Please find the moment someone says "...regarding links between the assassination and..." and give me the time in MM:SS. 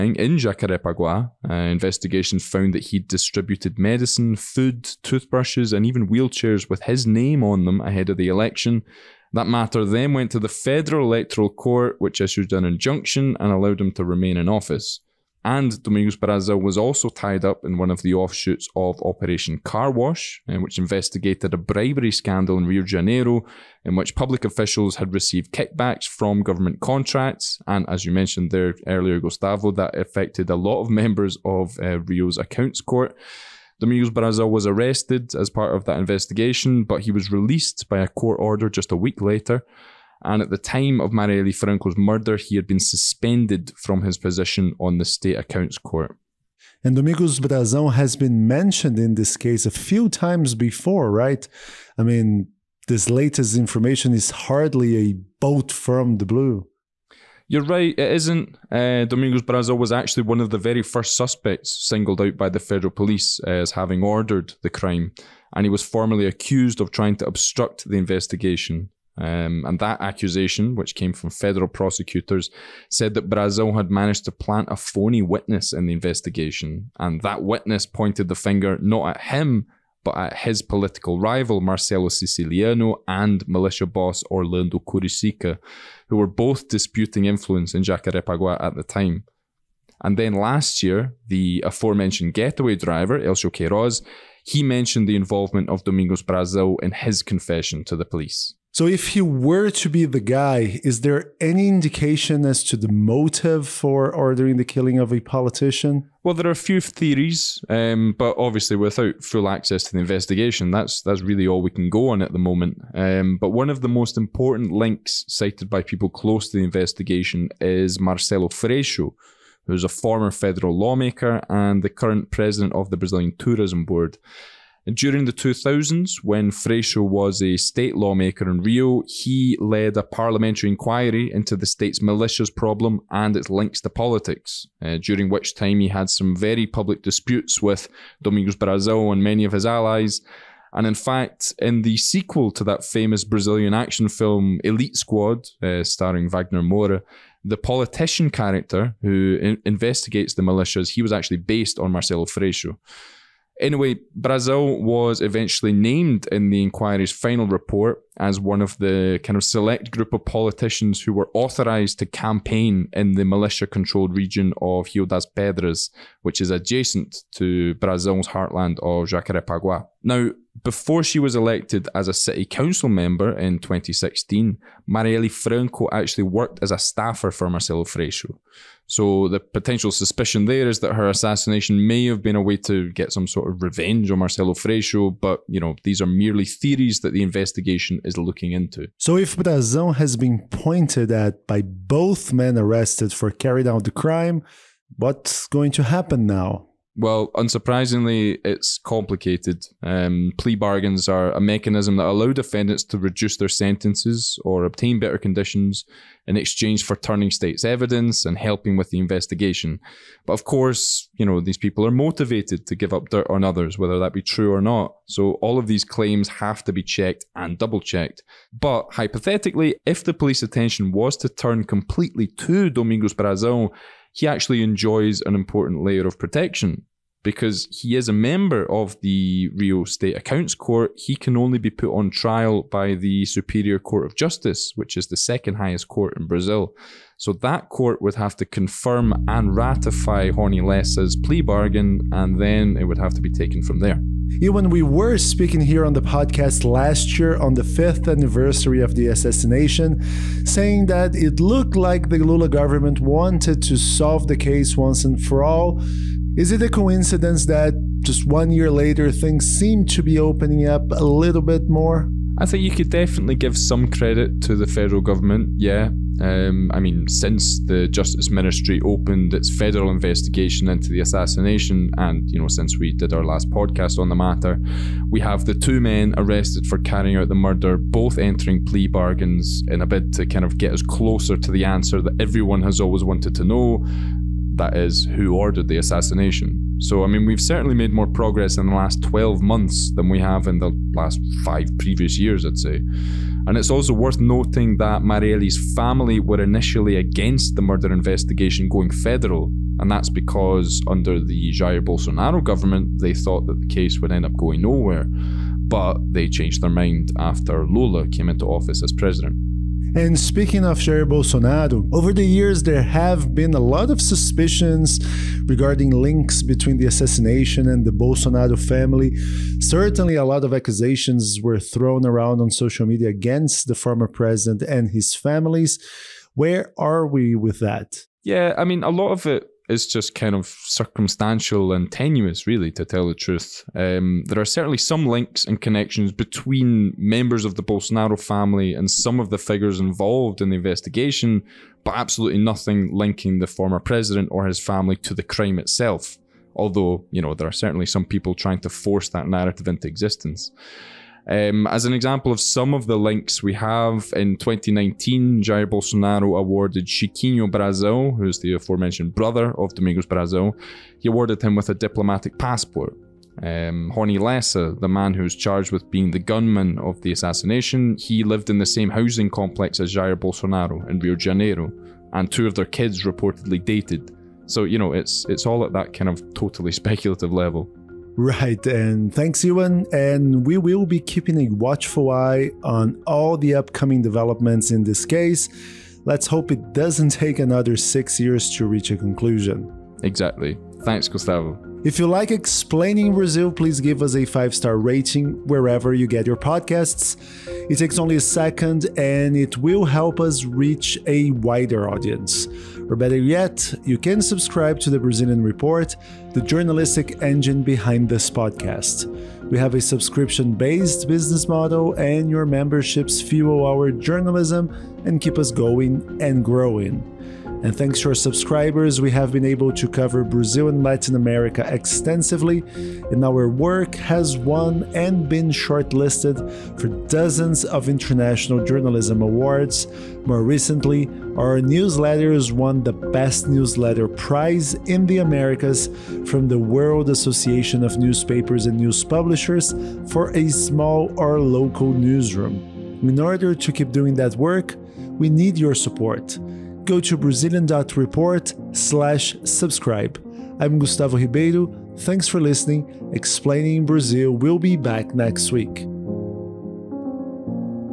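05:15.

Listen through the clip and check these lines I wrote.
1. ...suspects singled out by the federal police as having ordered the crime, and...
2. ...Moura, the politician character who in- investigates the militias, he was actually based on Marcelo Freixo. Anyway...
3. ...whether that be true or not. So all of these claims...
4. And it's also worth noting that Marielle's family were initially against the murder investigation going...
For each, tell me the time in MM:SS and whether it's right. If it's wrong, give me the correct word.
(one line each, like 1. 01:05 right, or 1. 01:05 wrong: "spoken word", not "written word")
1. 01:01 right
2. 02:26 right
3. 03:33 right
4. 04:53 right.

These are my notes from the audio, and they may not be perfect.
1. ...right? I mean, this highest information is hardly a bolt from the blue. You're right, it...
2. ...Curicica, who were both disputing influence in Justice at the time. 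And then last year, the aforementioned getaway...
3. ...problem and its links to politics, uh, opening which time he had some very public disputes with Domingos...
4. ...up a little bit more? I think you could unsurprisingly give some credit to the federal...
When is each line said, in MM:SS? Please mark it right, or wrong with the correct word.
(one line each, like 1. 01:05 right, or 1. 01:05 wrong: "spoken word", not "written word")
1. 00:51 wrong: "latest", not "highest"
2. 01:24 wrong: "Jacarepaguá", not "Justice"
3. 02:12 wrong: "during", not "opening"
4. 04:20 wrong: "definitely", not "unsurprisingly".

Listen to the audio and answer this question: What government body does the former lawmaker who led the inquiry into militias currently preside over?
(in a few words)
Brazilian Tourism Board.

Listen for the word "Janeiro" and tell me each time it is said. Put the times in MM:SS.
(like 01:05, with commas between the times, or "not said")
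00:22, 06:11.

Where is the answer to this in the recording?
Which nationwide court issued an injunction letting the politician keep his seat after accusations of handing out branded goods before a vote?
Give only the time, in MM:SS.
00:10.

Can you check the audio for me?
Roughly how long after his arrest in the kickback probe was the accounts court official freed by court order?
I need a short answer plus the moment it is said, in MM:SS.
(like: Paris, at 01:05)
a week, at 00:38.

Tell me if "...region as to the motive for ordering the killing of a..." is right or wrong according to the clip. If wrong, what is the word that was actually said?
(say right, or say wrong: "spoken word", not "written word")
wrong: "indication", not "region".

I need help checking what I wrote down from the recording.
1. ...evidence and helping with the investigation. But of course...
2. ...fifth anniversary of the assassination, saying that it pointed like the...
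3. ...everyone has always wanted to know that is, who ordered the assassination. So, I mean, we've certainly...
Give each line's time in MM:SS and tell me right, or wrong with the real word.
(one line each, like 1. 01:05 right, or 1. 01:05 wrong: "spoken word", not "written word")
1. 03:27 right
2. 04:07 wrong: "looked", not "pointed"
3. 04:42 right.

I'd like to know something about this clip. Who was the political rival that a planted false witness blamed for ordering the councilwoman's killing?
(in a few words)
Marcelo Siciliano.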